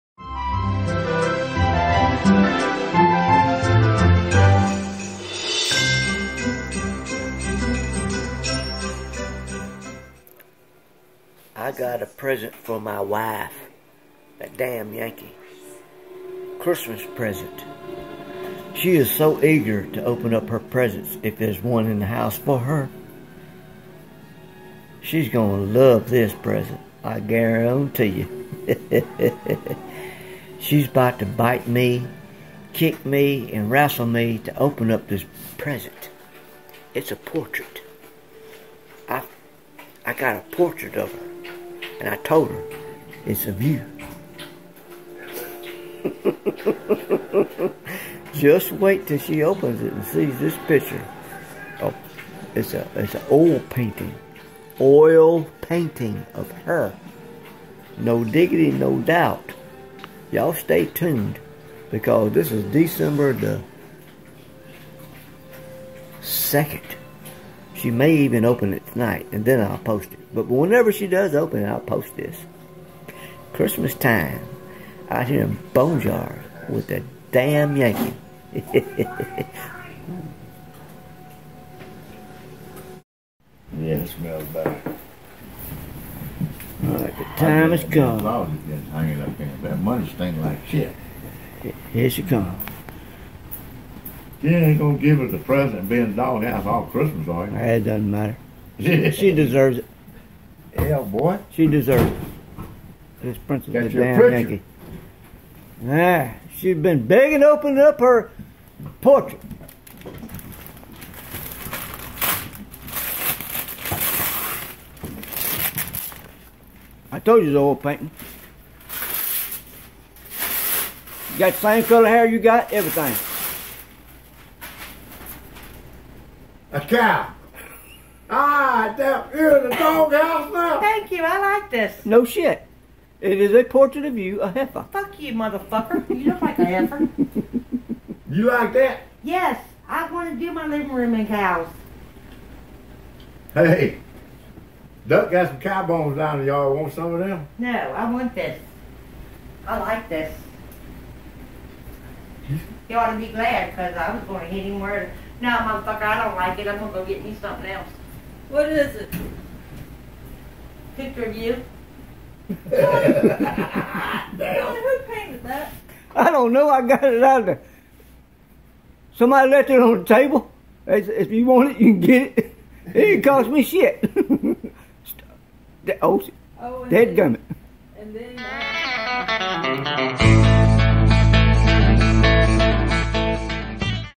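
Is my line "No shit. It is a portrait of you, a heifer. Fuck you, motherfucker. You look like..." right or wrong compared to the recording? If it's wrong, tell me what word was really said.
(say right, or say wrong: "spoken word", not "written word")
right.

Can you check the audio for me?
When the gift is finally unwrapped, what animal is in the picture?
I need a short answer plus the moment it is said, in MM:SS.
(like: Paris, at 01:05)
A cow, at 02:06.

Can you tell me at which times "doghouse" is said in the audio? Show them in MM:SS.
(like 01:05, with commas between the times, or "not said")
01:36, 02:09.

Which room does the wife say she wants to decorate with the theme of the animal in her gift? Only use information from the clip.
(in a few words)
Living room.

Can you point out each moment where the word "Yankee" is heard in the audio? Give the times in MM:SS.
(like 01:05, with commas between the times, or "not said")
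00:14, 01:17, 01:44.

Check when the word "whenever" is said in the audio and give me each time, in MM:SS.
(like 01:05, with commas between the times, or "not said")
01:10.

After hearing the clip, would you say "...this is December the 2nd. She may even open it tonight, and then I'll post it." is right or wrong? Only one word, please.
right.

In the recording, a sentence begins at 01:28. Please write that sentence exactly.
Hanging up in that money stain like shit.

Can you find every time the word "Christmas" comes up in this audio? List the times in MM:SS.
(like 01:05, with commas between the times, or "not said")
00:16, 01:13, 01:36.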